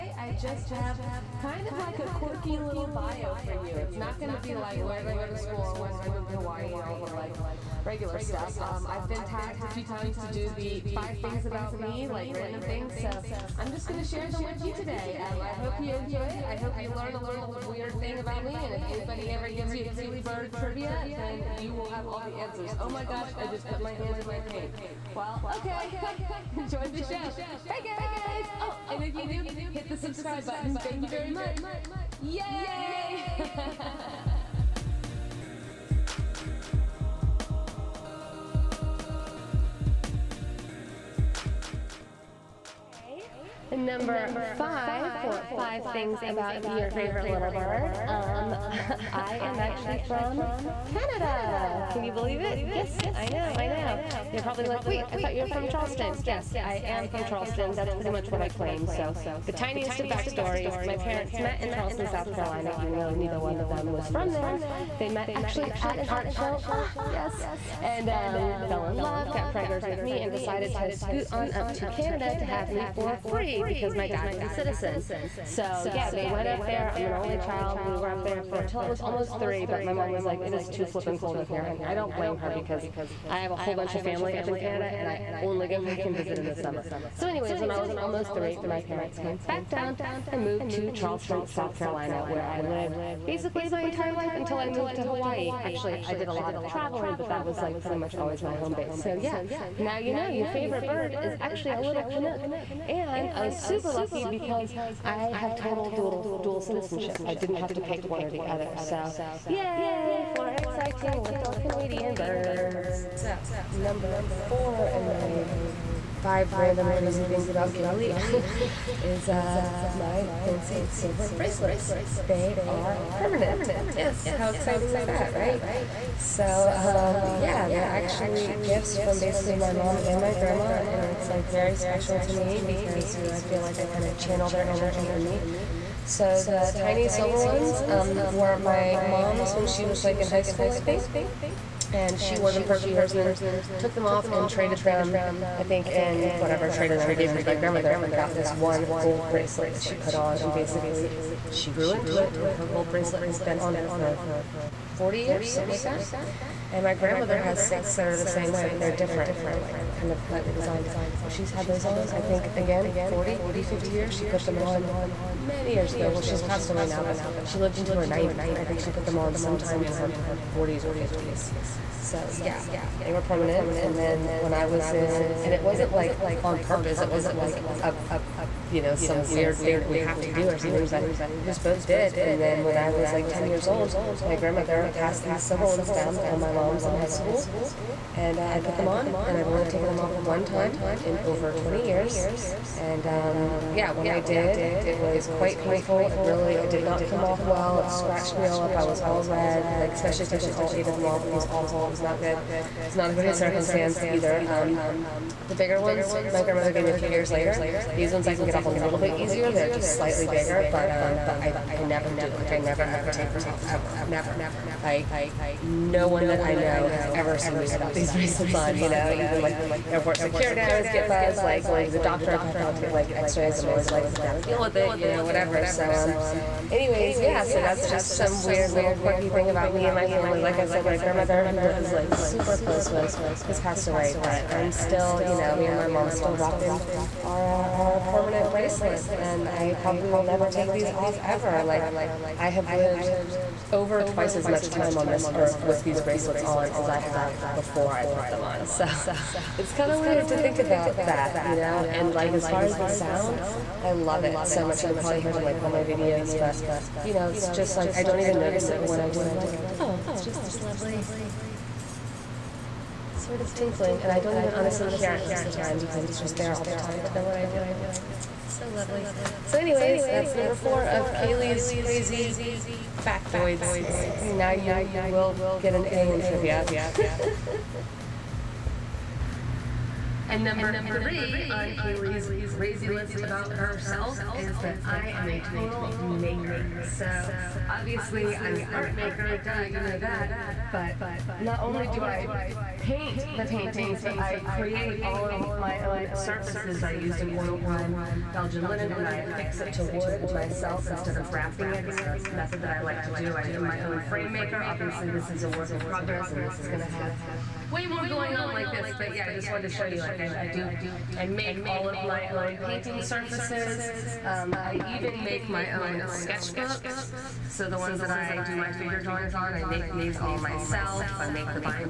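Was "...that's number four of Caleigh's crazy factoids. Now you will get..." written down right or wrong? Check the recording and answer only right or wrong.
right.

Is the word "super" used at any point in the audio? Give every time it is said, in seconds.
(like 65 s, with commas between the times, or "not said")
103 s, 232 s.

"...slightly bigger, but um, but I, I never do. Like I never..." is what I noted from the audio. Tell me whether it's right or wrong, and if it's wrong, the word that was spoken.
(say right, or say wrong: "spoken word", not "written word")
right.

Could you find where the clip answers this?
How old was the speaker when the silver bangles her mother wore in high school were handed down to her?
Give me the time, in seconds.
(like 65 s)
183 s.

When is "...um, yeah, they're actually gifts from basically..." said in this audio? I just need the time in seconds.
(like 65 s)
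126 s.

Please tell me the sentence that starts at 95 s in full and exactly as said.
Actually, I did a lot of traveling, but that was like pretty much always my home base.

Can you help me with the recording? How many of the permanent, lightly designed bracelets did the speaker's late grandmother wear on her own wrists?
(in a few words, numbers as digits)
6.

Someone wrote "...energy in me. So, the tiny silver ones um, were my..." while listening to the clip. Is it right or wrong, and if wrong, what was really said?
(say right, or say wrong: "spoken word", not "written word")
right.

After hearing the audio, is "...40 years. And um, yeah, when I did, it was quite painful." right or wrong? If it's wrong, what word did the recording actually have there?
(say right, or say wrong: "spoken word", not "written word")
wrong: "20", not "40".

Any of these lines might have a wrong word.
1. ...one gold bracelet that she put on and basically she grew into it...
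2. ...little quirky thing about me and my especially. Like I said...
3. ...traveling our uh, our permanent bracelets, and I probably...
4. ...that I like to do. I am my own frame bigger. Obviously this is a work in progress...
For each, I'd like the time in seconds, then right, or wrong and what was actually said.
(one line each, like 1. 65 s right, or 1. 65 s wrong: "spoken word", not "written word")
1. 148 s right
2. 228 s wrong: "family", not "especially"
3. 236 s wrong: "rocking", not "traveling"
4. 302 s wrong: "maker", not "bigger".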